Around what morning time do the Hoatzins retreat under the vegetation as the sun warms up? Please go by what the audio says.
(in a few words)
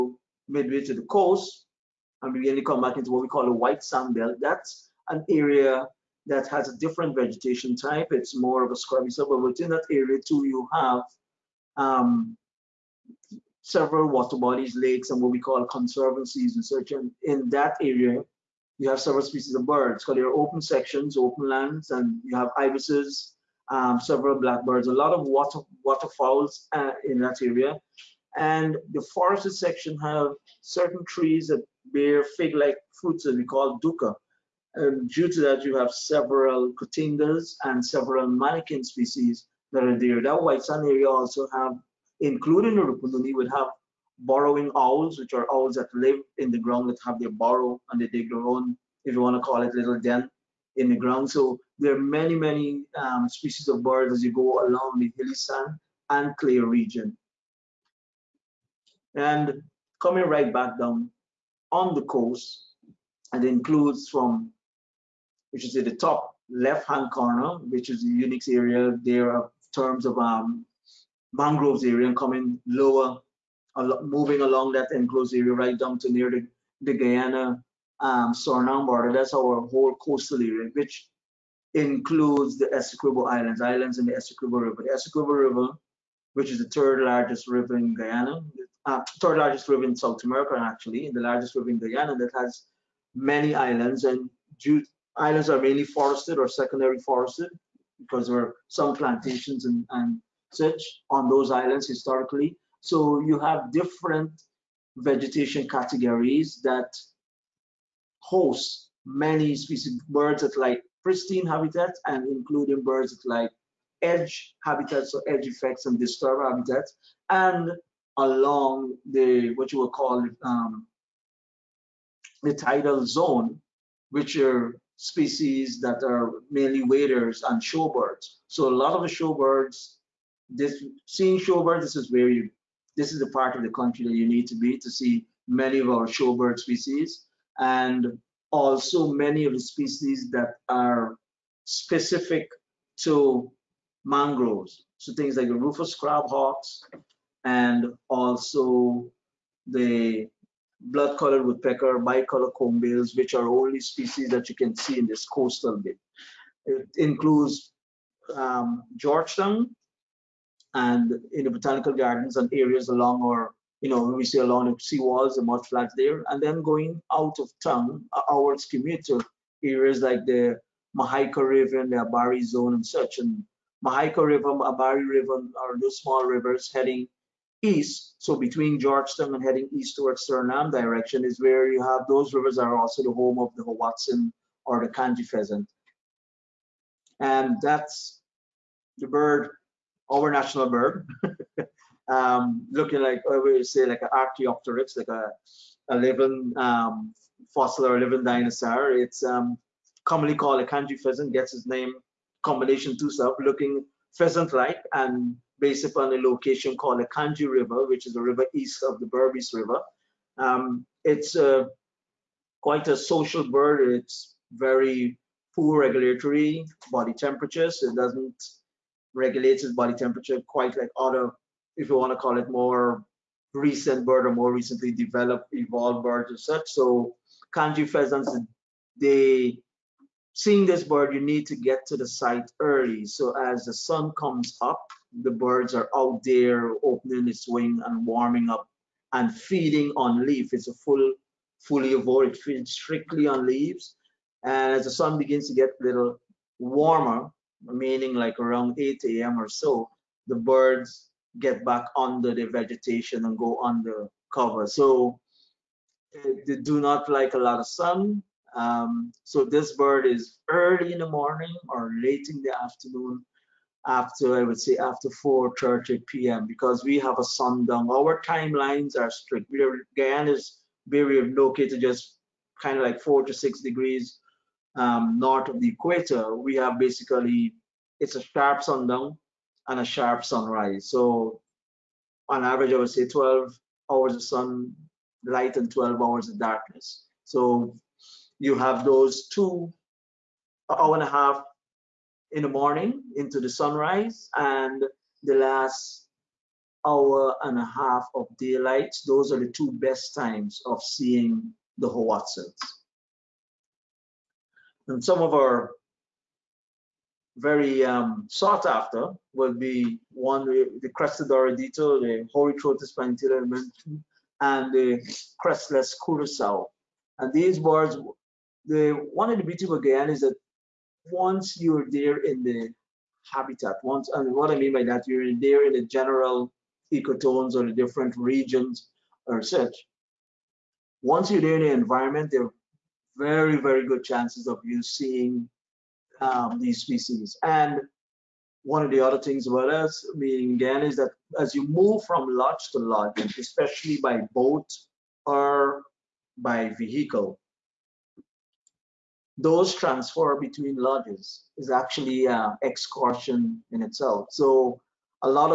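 8 a.m.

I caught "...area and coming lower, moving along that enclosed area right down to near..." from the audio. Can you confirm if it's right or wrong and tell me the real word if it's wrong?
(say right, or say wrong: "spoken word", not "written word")
right.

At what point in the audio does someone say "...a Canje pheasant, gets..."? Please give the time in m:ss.
3:20.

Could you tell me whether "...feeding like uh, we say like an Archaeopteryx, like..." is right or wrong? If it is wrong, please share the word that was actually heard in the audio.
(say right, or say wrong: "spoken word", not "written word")
wrong: "looking", not "feeding".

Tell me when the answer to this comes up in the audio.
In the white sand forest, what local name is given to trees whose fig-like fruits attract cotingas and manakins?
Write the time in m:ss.
0:33.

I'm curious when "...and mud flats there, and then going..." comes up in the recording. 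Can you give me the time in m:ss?
2:45.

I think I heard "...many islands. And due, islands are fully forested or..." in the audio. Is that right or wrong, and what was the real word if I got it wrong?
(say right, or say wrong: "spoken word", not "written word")
wrong: "mainly", not "fully".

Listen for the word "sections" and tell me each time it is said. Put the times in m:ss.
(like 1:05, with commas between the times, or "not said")
0:20, 0:29.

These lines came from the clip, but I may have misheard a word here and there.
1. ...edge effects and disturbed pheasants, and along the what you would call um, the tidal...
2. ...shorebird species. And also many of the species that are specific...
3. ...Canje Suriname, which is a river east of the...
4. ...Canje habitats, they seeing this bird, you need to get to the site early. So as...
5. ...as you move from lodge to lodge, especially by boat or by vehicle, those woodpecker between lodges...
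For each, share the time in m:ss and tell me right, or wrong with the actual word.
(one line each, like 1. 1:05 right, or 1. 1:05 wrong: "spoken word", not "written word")
1. 1:55 wrong: "habitats", not "pheasants"
2. 2:16 right
3. 3:27 wrong: "River", not "Suriname"
4. 3:47 wrong: "pheasants", not "habitats"
5. 5:41 wrong: "transfer", not "woodpecker".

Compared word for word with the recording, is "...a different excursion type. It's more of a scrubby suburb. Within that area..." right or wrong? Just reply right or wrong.
wrong.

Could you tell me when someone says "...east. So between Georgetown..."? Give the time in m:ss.
2:57.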